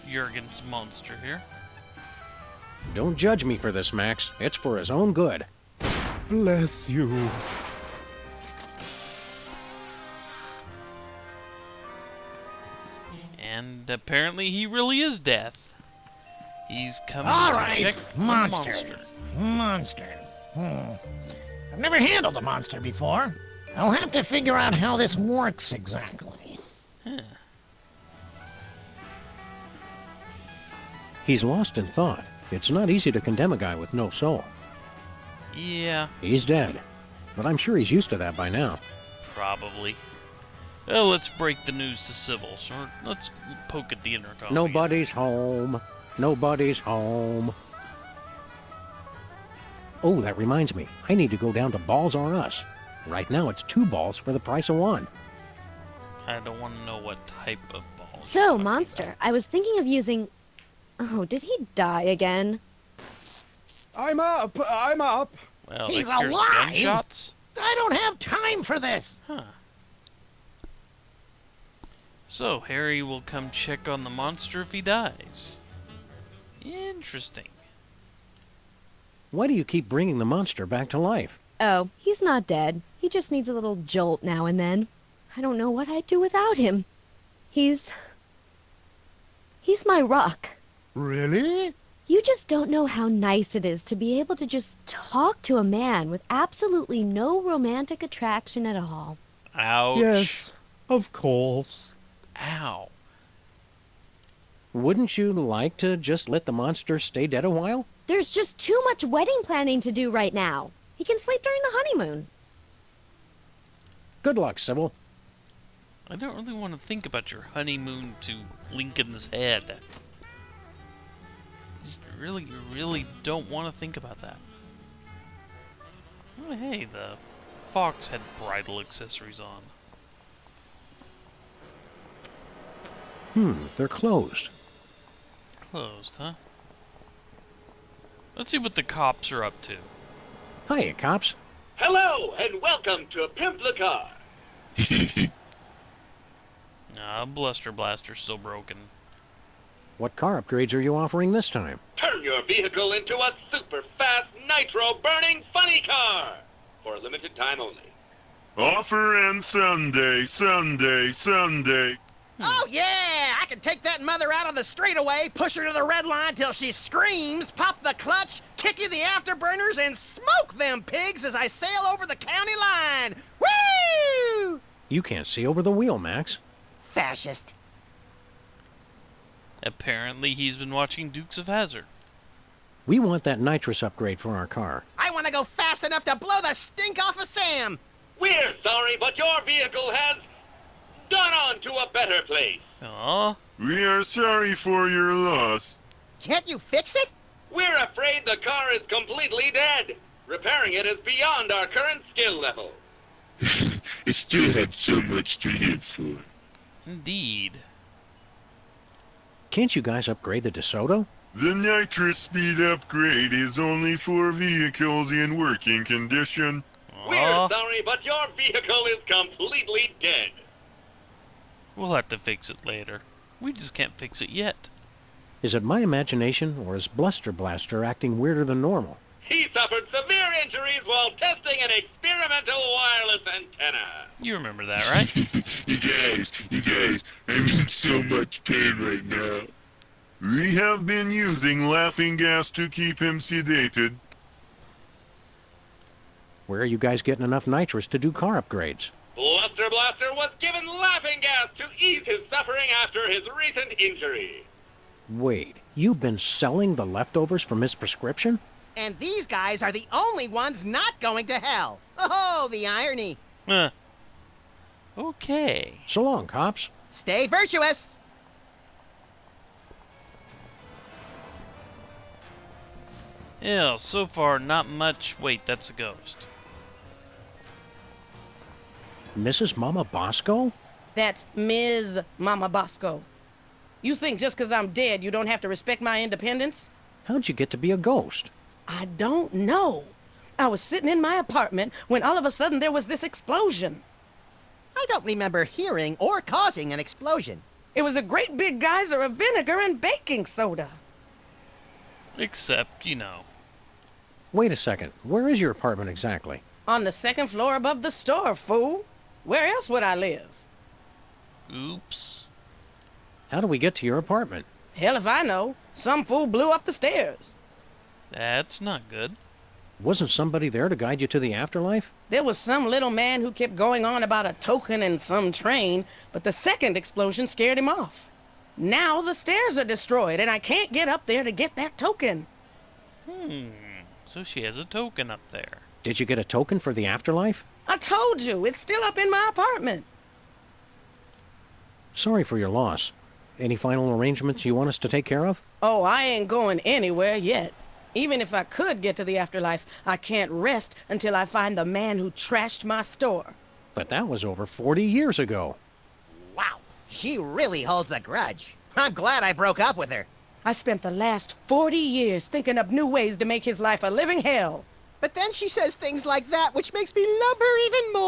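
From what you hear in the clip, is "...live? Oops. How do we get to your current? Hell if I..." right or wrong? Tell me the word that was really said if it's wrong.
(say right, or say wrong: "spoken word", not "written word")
wrong: "apartment", not "current".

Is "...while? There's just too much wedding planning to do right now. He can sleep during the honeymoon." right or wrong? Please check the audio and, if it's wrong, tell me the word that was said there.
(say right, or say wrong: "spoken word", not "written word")
right.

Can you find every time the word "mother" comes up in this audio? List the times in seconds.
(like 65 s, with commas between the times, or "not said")
164 s.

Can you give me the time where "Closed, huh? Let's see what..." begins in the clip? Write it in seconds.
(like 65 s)
135 s.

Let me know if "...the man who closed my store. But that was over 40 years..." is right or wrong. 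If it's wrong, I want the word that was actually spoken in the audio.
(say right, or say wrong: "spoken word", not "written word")
wrong: "trashed", not "closed".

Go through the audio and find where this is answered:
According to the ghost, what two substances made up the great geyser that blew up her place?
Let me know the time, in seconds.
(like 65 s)
299 s.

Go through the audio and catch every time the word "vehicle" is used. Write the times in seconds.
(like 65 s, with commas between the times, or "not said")
152 s, 189 s, 214 s, 218 s.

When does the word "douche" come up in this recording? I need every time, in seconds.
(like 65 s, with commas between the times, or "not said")
not said.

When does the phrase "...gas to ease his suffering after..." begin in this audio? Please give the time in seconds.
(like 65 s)
251 s.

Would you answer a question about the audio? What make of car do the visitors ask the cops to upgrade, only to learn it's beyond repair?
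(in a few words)
DeSoto.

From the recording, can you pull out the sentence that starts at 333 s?
Hmm, so she has a token up there.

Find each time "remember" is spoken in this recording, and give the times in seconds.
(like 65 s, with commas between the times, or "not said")
234 s, 295 s.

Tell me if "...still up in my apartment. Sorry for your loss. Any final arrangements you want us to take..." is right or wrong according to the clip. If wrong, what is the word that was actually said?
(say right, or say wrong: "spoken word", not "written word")
right.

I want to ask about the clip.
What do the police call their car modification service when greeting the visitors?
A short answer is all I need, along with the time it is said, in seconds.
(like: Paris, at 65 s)
Pimp the Car, at 143 s.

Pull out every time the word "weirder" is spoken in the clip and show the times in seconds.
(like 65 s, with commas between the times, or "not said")
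228 s.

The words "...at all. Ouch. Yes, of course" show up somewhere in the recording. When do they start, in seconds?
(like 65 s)
98 s.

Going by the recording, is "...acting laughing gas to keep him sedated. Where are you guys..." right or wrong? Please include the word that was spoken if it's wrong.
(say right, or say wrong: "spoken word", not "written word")
wrong: "using", not "acting".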